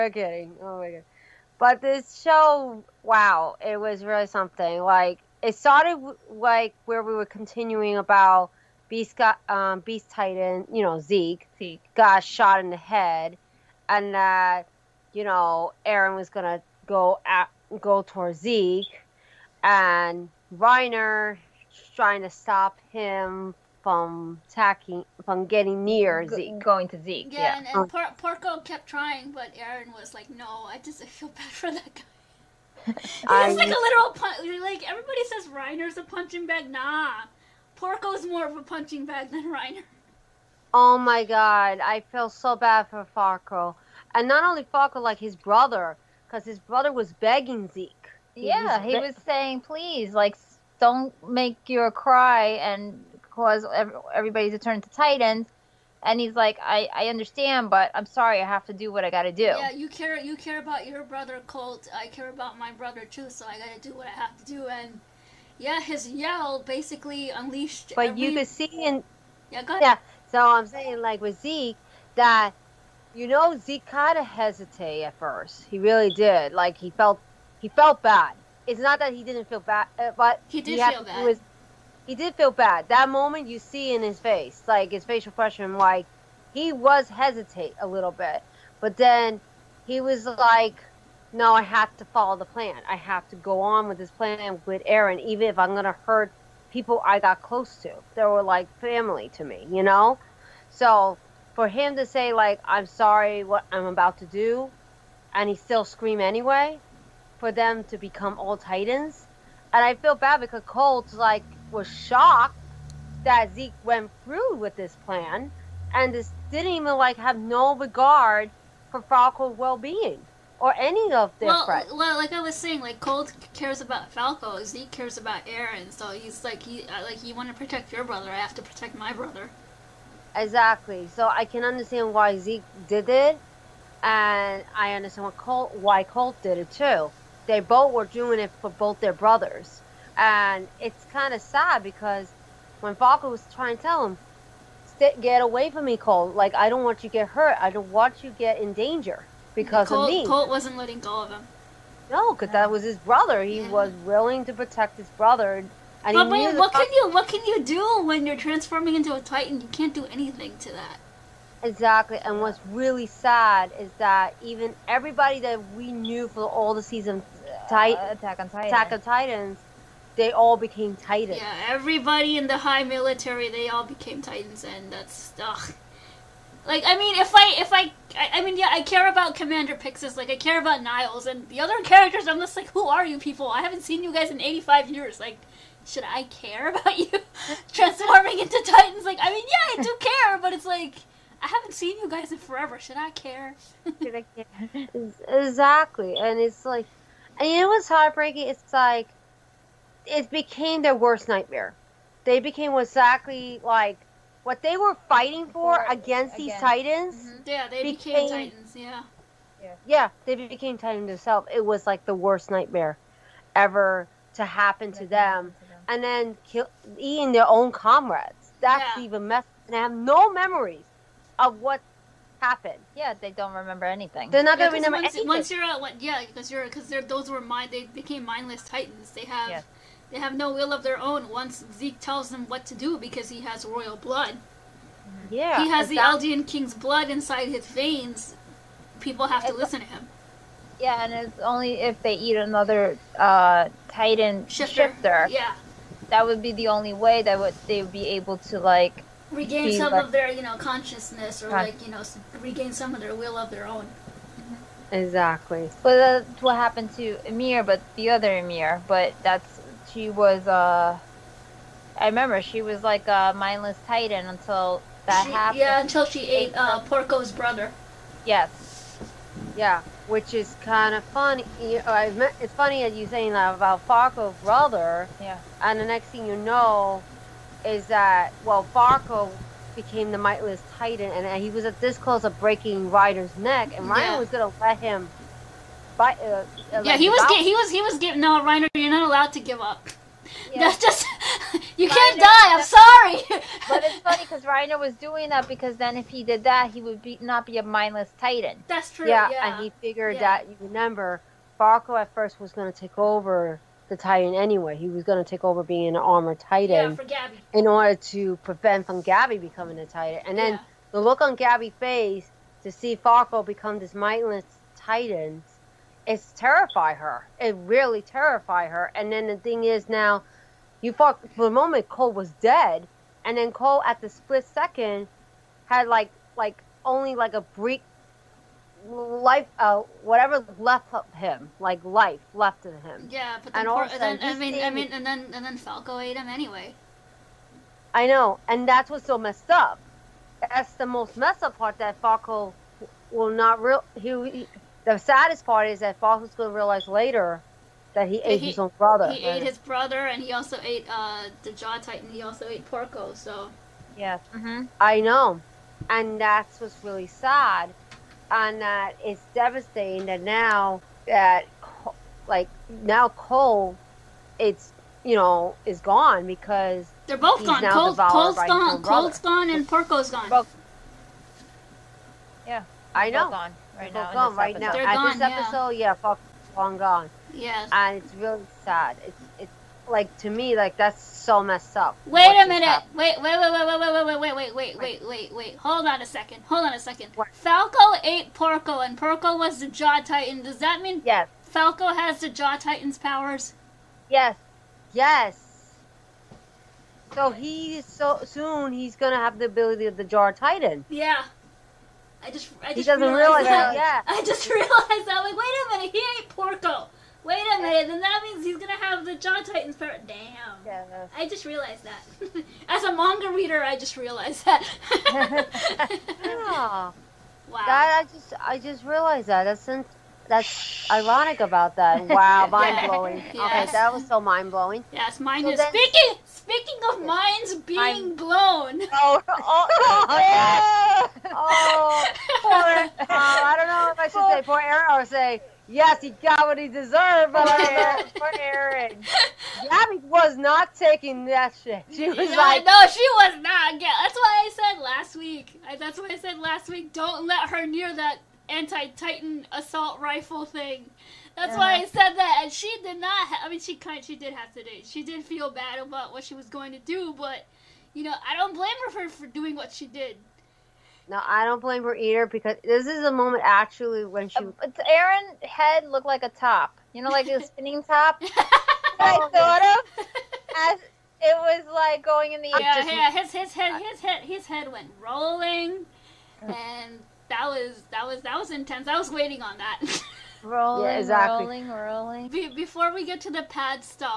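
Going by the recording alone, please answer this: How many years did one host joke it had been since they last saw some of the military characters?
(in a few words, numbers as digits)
85.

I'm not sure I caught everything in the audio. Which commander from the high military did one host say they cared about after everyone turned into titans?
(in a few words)
Commander Pixis.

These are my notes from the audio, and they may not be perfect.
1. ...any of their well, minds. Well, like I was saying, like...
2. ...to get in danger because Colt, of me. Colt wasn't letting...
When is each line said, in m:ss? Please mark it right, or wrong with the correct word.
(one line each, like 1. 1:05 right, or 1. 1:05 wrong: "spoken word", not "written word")
1. 2:00 wrong: "friends", not "minds"
2. 2:28 right.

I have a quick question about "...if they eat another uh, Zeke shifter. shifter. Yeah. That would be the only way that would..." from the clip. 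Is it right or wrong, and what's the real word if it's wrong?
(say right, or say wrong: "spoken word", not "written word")
wrong: "Titan", not "Zeke".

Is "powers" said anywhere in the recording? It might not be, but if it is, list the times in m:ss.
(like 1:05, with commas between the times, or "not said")
6:32, 6:49.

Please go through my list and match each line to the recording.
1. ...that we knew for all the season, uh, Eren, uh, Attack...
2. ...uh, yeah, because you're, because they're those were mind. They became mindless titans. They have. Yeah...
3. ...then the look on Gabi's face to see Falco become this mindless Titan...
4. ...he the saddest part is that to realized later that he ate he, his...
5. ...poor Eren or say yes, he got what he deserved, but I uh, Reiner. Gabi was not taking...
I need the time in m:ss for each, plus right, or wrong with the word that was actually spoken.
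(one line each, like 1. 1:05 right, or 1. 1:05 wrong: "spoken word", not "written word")
1. 2:45 wrong: "Titan", not "Eren"
2. 3:45 right
3. 5:10 right
4. 5:44 right
5. 7:14 wrong: "Eren", not "Reiner".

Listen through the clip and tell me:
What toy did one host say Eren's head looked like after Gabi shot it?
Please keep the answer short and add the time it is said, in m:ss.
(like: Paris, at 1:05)
spinning top, at 7:47.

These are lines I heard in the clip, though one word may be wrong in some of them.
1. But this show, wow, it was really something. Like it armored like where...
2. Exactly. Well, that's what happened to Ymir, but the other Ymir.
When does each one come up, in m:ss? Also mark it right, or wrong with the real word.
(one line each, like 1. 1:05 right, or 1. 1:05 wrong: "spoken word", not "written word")
1. 0:01 wrong: "started", not "armored"
2. 4:14 right.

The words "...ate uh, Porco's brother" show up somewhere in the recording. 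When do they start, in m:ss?
4:26.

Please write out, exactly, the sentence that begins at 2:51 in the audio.
Yeah, everybody in the high military, they all became titans, and that's ugh.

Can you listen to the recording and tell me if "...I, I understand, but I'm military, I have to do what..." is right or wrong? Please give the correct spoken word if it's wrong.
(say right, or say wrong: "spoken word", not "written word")
wrong: "sorry", not "military".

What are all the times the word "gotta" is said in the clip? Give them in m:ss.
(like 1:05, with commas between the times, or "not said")
0:59, 1:03.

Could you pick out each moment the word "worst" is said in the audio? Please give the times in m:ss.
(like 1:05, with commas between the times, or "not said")
3:20, 3:32.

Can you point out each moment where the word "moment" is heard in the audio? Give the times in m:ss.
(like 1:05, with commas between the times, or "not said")
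1:23, 5:21, 7:43.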